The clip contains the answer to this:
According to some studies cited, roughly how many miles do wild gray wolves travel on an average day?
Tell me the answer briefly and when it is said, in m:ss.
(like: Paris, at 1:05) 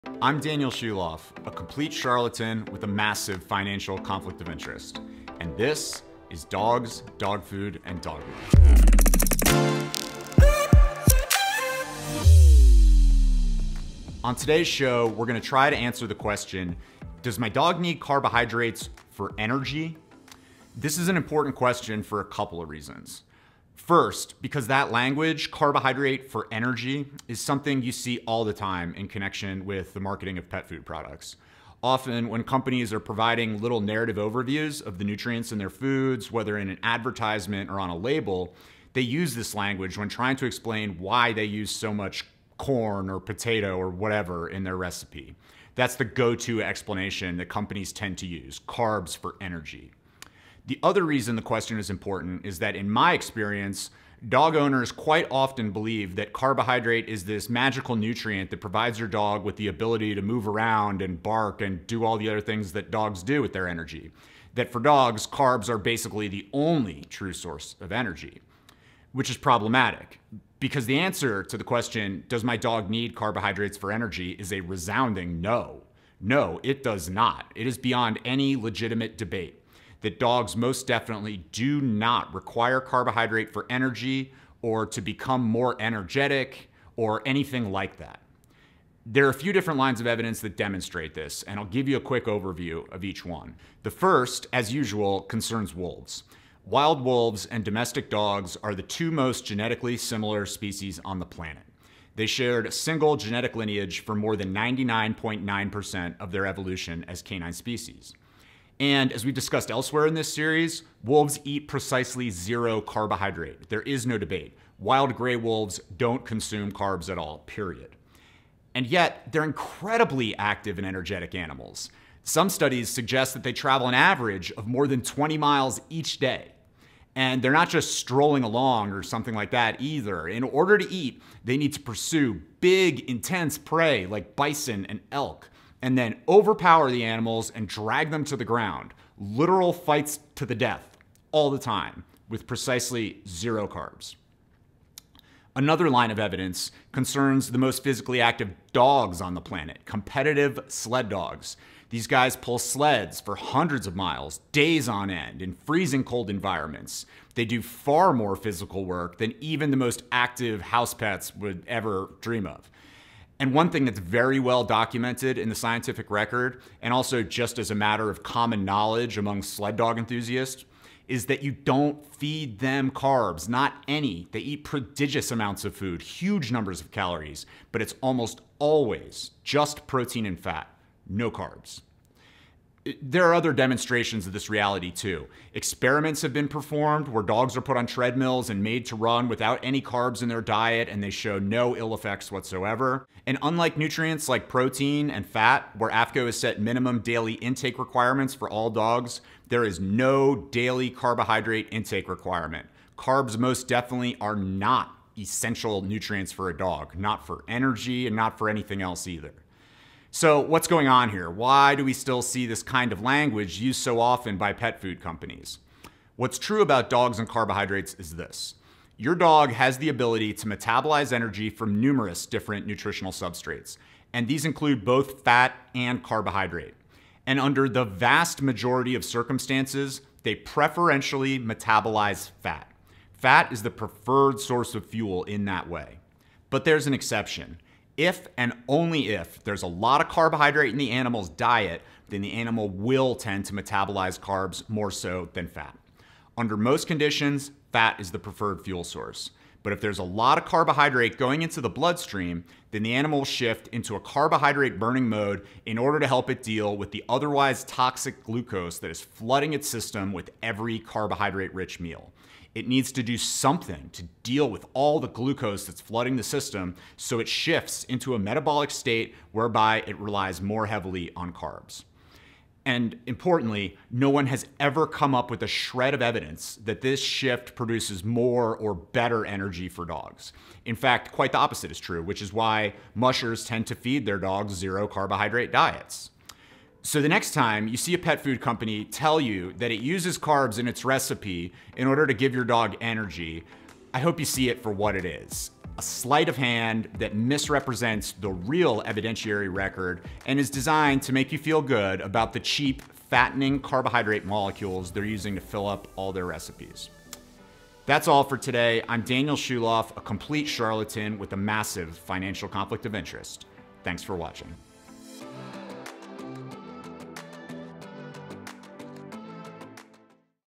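more than 20 miles, at 2:04.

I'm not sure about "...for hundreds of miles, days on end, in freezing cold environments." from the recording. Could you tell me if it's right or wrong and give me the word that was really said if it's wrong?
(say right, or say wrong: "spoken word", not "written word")
right.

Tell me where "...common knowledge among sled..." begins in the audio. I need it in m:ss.
2:48.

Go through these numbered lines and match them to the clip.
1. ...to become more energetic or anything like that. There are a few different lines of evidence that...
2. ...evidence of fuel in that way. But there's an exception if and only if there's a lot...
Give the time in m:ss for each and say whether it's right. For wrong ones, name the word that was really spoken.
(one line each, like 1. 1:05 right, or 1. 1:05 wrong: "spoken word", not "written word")
1. 1:24 right
2. 3:54 wrong: "source", not "evidence".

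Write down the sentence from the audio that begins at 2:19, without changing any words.
Literal fights to the death all the time with precisely zero carbs.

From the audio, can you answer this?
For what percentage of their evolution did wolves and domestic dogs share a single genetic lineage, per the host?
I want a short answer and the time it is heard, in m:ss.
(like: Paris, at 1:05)
more than 99.9%, at 1:44.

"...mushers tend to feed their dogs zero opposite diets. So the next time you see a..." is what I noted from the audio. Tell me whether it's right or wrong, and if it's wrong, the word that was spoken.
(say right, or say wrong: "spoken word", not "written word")
wrong: "carbohydrate", not "opposite".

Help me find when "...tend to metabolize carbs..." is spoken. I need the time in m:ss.
4:03.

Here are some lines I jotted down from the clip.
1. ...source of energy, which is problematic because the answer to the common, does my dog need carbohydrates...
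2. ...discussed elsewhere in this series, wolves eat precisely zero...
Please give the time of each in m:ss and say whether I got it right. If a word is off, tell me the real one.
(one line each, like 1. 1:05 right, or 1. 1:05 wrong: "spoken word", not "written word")
1. 1:07 wrong: "question", not "common"
2. 1:49 right.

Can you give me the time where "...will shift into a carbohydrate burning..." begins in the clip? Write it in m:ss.
4:13.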